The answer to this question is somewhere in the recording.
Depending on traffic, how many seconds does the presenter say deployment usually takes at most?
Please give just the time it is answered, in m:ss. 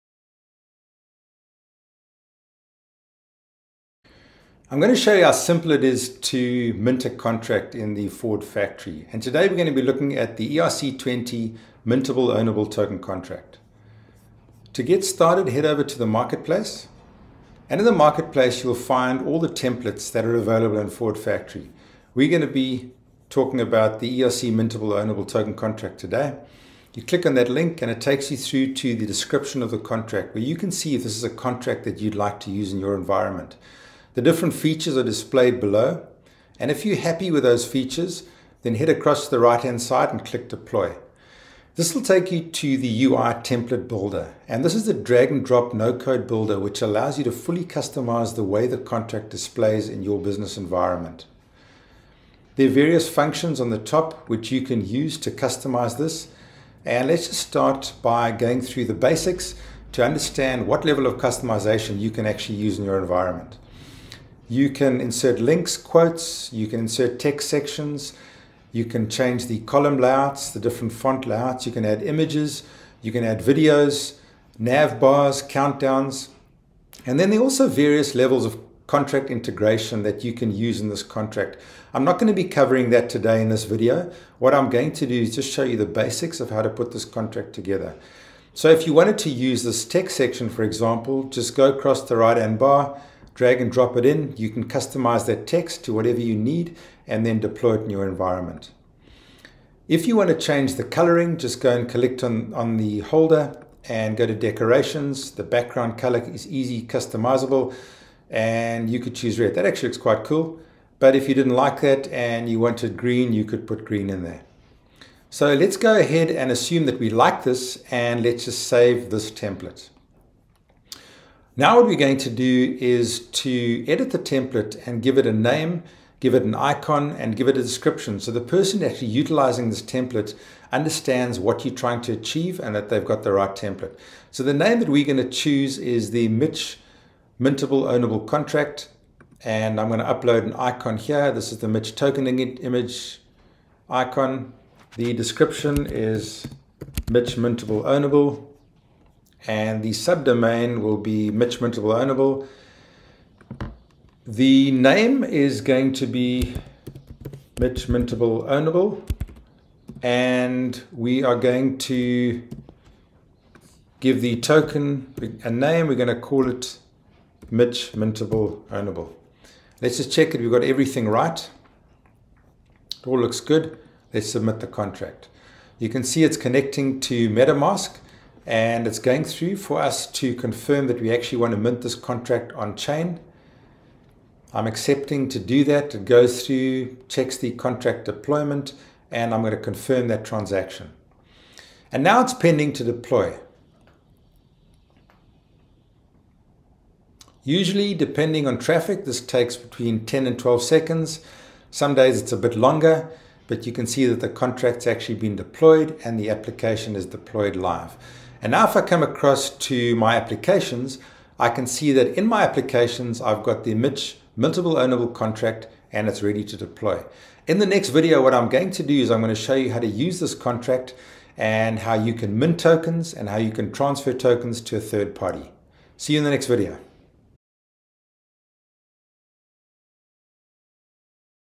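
3:20.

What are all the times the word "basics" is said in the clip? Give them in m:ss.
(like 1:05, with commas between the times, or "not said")
0:58, 1:25.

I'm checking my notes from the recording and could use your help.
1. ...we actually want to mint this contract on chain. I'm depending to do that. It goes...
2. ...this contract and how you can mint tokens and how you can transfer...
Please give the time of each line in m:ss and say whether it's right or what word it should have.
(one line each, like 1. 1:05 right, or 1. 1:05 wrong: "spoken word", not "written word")
1. 3:01 wrong: "accepting", not "depending"
2. 3:40 right.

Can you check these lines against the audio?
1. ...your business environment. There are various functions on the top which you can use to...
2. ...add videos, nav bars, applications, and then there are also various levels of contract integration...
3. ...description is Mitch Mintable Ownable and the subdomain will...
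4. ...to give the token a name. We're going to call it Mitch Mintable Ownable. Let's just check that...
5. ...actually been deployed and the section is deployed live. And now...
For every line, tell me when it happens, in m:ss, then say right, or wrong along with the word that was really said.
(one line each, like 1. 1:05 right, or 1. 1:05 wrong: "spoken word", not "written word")
1. 0:50 right
2. 1:13 wrong: "countdowns", not "applications"
3. 2:25 right
4. 2:41 right
5. 3:24 wrong: "application", not "section".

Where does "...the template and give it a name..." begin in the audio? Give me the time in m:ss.
2:04.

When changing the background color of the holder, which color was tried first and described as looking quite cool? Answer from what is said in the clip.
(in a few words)
Red.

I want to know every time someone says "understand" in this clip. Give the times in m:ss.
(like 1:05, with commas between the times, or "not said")
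1:00, 2:10.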